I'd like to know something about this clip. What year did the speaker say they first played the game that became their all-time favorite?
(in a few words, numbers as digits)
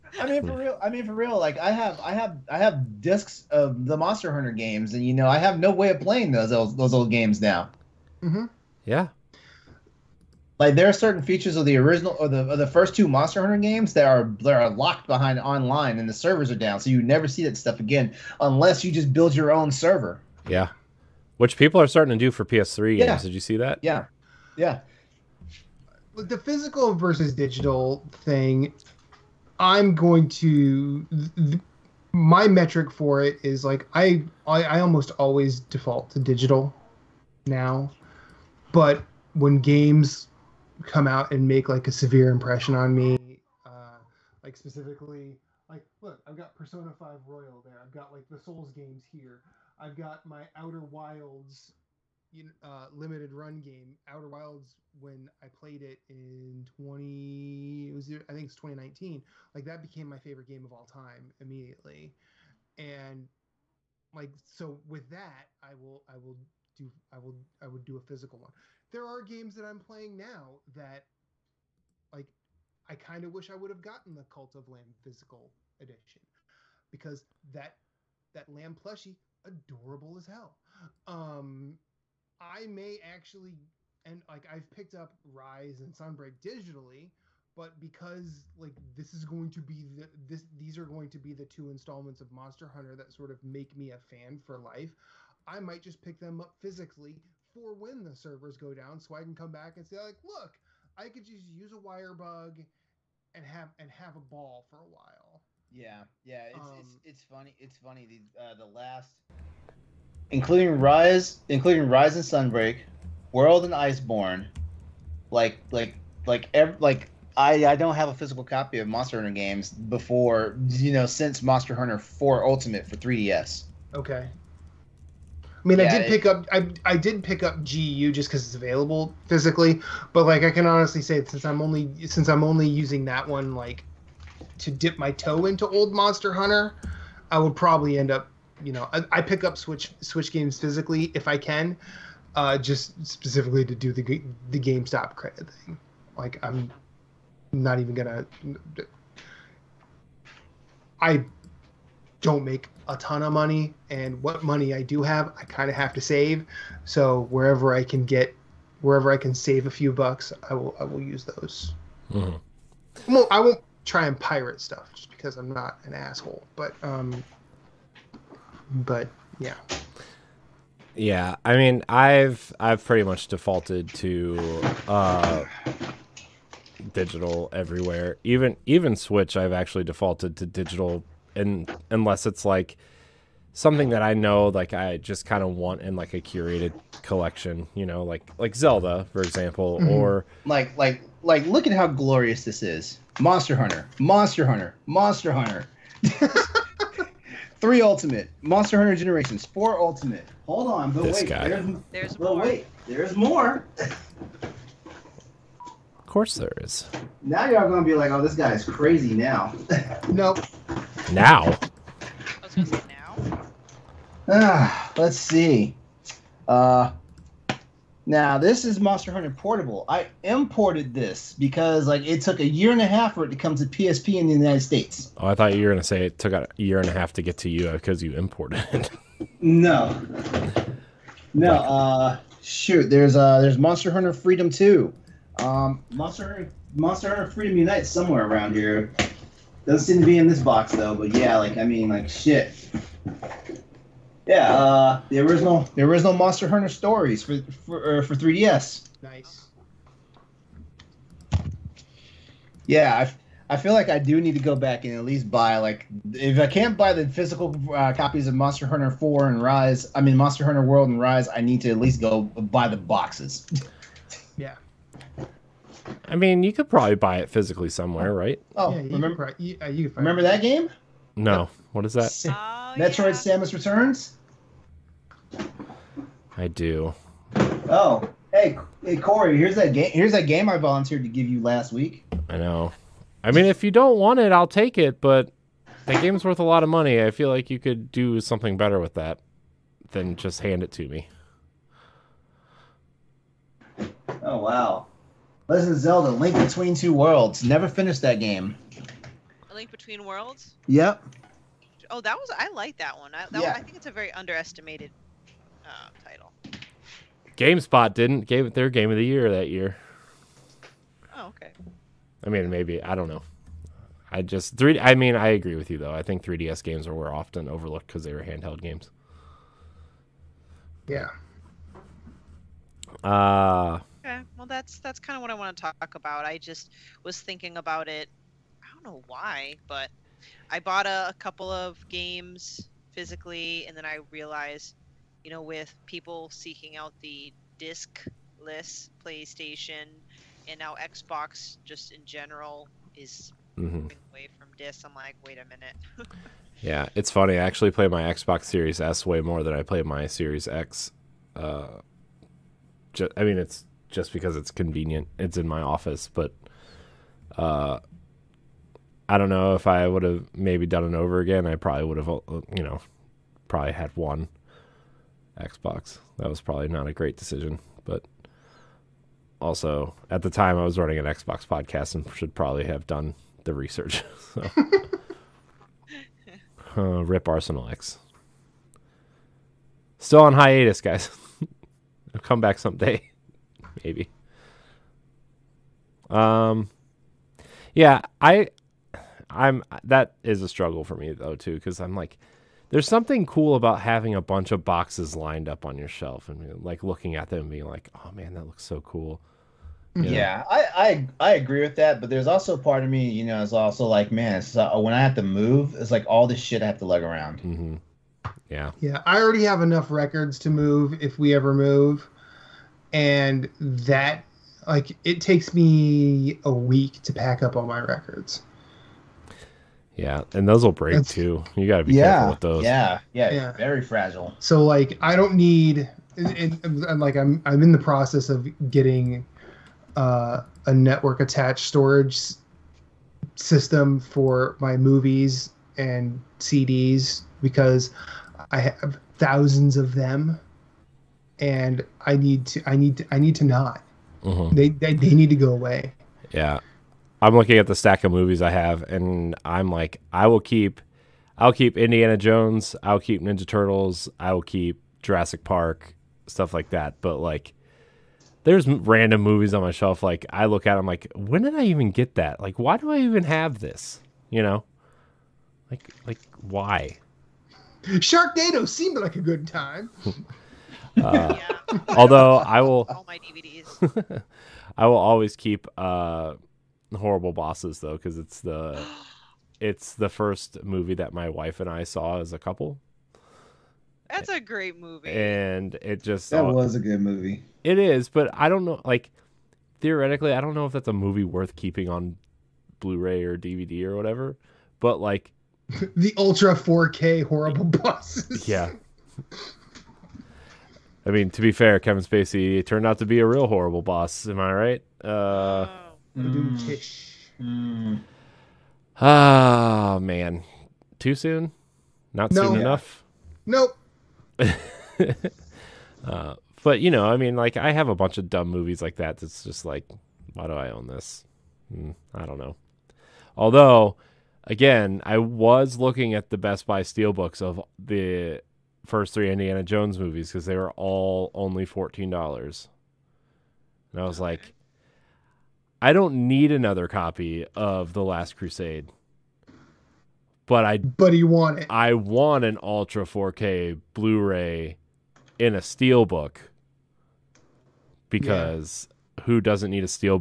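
2019.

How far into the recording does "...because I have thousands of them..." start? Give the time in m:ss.
7:17.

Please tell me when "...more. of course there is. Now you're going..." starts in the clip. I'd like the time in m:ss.
3:23.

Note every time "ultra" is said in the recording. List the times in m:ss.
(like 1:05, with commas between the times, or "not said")
8:16, 9:02.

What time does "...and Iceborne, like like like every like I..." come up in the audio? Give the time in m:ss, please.
1:53.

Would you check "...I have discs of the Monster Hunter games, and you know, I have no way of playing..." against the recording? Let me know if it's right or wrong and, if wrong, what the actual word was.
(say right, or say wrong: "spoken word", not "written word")
right.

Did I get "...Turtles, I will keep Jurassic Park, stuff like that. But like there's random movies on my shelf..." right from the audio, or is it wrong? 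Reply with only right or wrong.
right.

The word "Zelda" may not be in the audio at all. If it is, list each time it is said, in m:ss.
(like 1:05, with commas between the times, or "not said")
3:08, 4:55.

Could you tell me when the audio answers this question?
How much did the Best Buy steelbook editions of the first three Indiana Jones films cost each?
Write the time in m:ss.
8:51.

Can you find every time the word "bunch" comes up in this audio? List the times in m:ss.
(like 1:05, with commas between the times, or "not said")
6:34, 8:37.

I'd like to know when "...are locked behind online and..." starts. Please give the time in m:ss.
0:14.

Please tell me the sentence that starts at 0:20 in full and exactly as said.
Yeah, which people are starting to do for PS3 yeah.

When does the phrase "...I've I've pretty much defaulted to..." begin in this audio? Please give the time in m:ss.
2:51.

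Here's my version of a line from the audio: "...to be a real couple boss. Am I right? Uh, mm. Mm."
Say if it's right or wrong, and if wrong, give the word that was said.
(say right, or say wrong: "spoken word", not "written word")
wrong: "horrible", not "couple".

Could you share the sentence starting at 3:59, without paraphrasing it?
Doesn't seem to be in this box though, but yeah, like I mean, like shit.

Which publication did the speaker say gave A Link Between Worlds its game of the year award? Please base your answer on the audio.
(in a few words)
GameSpot.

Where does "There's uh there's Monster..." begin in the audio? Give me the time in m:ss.
3:52.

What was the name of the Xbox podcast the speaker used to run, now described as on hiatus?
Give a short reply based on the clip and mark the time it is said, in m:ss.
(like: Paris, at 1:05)
Arsenal X, at 6:17.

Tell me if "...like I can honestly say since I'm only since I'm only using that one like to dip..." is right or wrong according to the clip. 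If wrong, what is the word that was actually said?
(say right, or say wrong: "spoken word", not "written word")
right.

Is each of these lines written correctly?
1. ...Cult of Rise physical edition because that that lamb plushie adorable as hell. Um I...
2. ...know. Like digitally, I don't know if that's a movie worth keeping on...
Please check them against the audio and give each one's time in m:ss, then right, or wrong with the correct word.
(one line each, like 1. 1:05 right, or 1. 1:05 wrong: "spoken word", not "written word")
1. 1:14 wrong: "Lamb", not "Rise"
2. 8:08 wrong: "theoretically", not "digitally".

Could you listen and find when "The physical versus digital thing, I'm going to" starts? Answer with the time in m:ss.
0:26.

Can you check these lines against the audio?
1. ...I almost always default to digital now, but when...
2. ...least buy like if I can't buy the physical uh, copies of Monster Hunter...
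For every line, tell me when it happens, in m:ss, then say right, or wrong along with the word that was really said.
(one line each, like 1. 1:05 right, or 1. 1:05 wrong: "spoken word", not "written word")
1. 0:34 right
2. 4:15 right.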